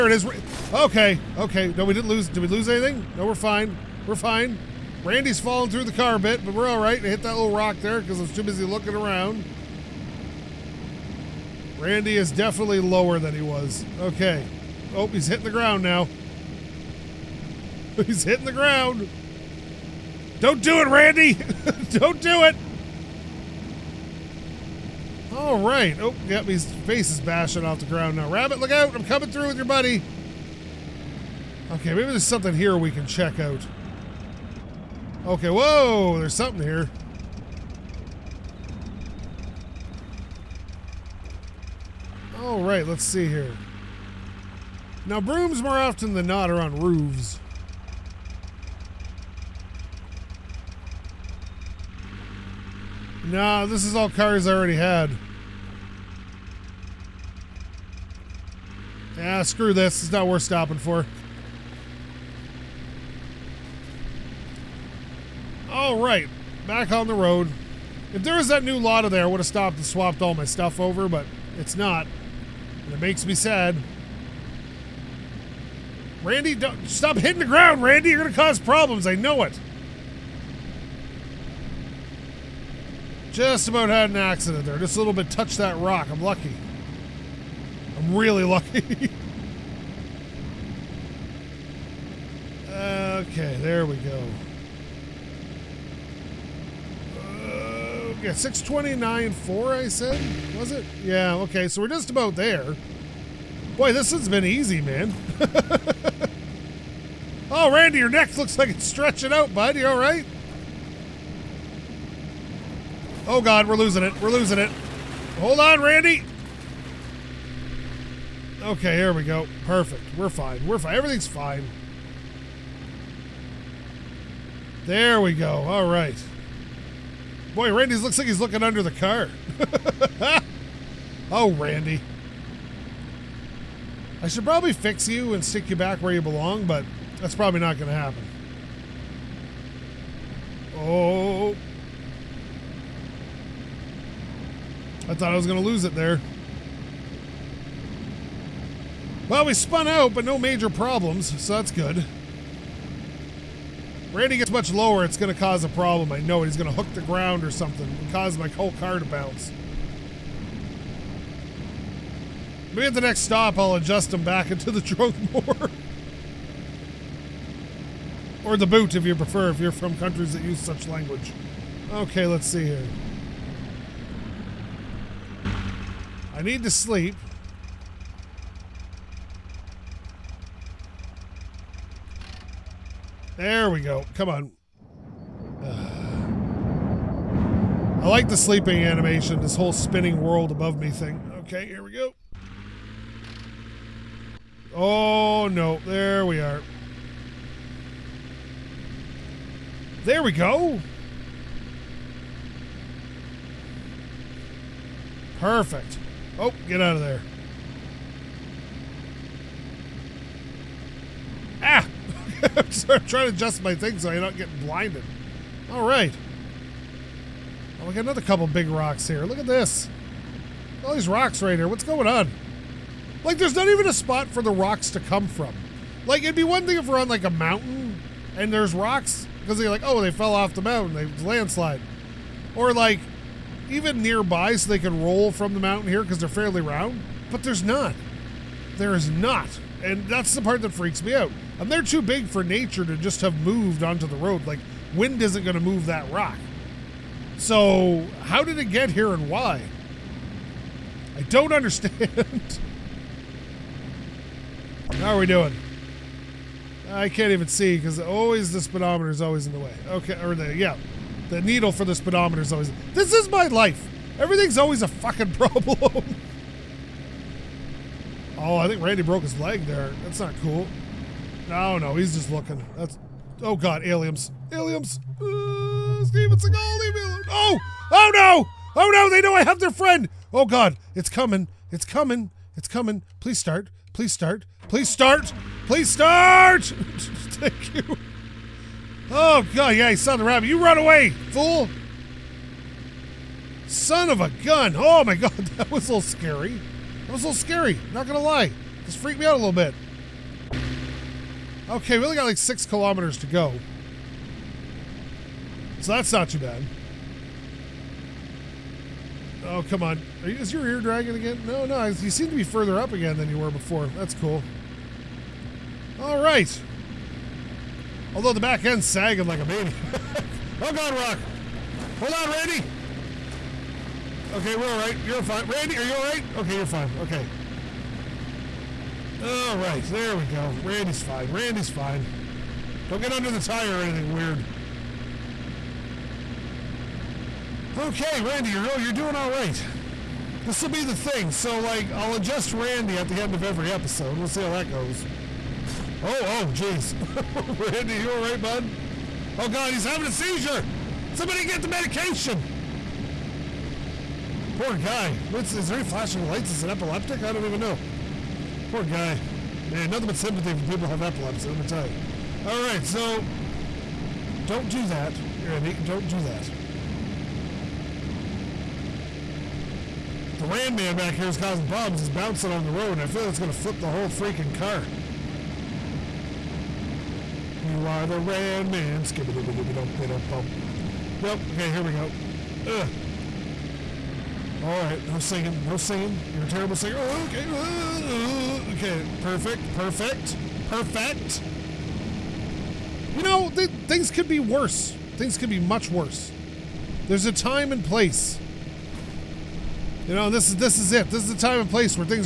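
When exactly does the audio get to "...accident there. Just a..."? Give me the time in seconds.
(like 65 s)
84 s.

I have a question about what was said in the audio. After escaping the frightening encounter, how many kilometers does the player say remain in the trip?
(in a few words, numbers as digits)
6.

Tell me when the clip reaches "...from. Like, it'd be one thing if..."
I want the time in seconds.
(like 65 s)
225 s.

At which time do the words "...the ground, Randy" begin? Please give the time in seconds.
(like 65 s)
77 s.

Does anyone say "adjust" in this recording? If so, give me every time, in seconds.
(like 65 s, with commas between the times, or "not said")
163 s, 213 s, 342 s.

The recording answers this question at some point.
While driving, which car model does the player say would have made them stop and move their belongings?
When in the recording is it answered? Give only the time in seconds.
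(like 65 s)
68 s.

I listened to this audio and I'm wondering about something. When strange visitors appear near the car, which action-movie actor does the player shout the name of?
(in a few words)
Steven Seagal.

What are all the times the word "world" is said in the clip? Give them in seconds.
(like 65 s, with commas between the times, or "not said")
190 s.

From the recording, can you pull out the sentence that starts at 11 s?
Randy is definitely lower than he was.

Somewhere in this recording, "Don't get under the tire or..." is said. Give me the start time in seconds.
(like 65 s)
332 s.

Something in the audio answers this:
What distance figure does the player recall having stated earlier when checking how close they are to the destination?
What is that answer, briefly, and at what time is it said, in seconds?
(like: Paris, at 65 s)
629.4, at 98 s.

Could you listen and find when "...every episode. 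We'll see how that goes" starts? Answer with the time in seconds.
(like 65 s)
343 s.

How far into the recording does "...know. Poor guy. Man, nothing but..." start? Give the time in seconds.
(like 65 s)
357 s.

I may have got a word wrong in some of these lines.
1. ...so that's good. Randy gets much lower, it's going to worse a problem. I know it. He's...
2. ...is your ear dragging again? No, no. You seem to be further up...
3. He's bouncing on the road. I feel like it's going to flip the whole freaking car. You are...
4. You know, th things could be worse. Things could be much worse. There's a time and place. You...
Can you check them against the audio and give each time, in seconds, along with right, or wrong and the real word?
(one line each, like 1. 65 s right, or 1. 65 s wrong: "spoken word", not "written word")
1. 151 s wrong: "cause", not "worse"
2. 310 s right
3. 371 s right
4. 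393 s right.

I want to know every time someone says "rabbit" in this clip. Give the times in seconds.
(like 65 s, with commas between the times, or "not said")
28 s, 290 s.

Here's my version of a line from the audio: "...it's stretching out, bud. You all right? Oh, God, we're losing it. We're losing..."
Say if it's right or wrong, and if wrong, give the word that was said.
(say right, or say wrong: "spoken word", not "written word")
right.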